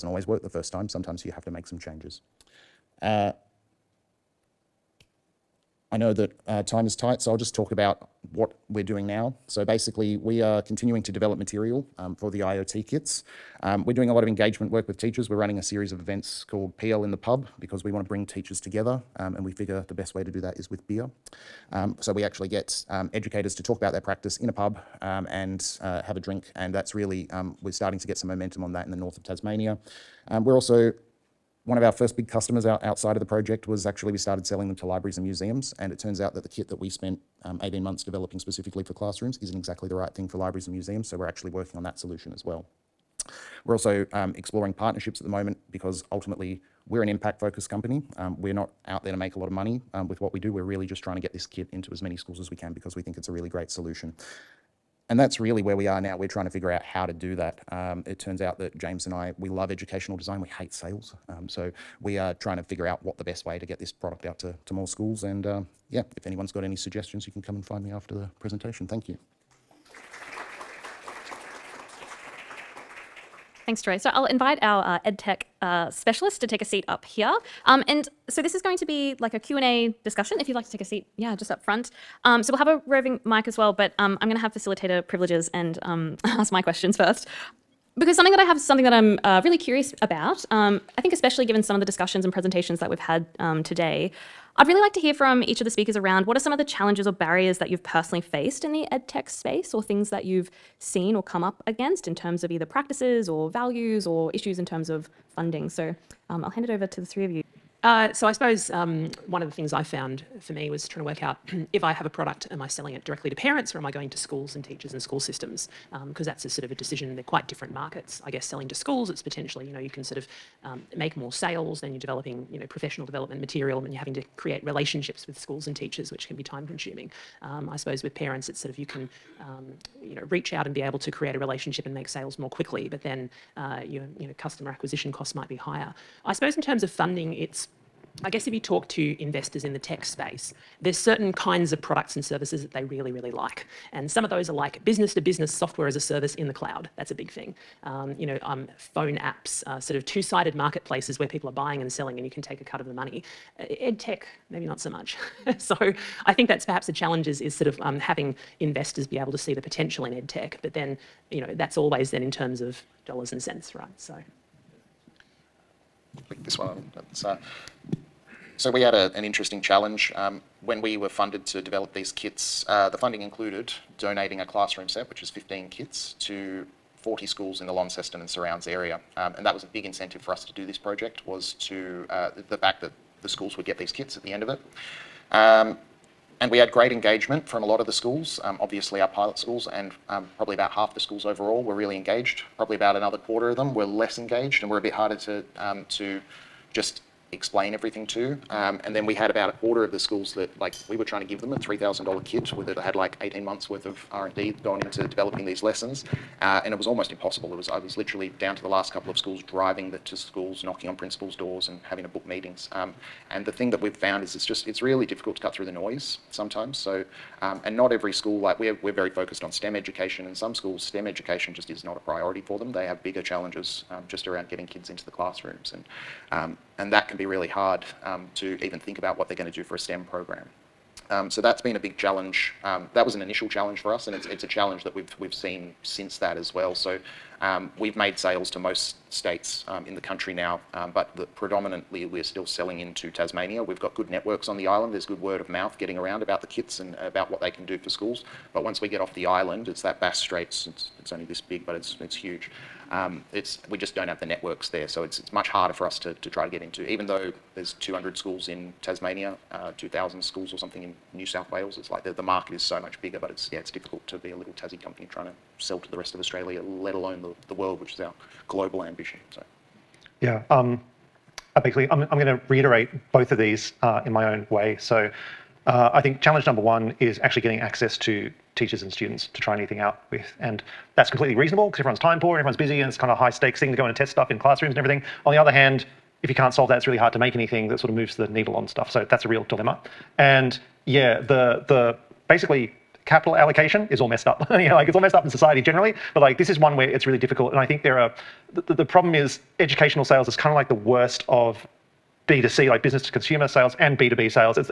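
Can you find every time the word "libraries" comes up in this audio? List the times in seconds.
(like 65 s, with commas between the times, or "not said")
34 s, 40 s.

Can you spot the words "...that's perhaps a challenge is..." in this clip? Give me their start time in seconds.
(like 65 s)
156 s.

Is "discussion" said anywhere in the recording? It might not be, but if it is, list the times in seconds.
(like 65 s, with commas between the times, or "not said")
80 s, 91 s.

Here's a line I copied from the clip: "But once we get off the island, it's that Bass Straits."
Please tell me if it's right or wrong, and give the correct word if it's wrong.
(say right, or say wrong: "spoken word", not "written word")
right.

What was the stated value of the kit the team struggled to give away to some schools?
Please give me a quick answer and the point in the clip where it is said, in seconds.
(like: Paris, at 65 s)
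$3,000, at 201 s.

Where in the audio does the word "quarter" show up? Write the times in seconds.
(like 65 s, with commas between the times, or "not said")
193 s, 199 s.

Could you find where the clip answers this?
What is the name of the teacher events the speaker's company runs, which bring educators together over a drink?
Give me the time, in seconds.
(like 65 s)
16 s.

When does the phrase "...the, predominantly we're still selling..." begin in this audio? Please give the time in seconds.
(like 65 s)
241 s.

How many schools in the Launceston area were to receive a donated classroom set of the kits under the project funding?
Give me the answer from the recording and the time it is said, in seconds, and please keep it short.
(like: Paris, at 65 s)
40, at 176 s.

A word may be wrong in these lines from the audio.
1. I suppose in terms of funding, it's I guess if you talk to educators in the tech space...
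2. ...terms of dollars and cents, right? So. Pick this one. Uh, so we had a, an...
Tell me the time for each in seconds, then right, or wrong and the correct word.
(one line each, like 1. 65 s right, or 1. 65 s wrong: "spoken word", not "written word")
1. 136 s wrong: "investors", not "educators"
2. 162 s right.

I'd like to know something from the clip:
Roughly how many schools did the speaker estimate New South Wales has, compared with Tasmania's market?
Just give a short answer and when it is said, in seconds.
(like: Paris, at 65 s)
2,000, at 259 s.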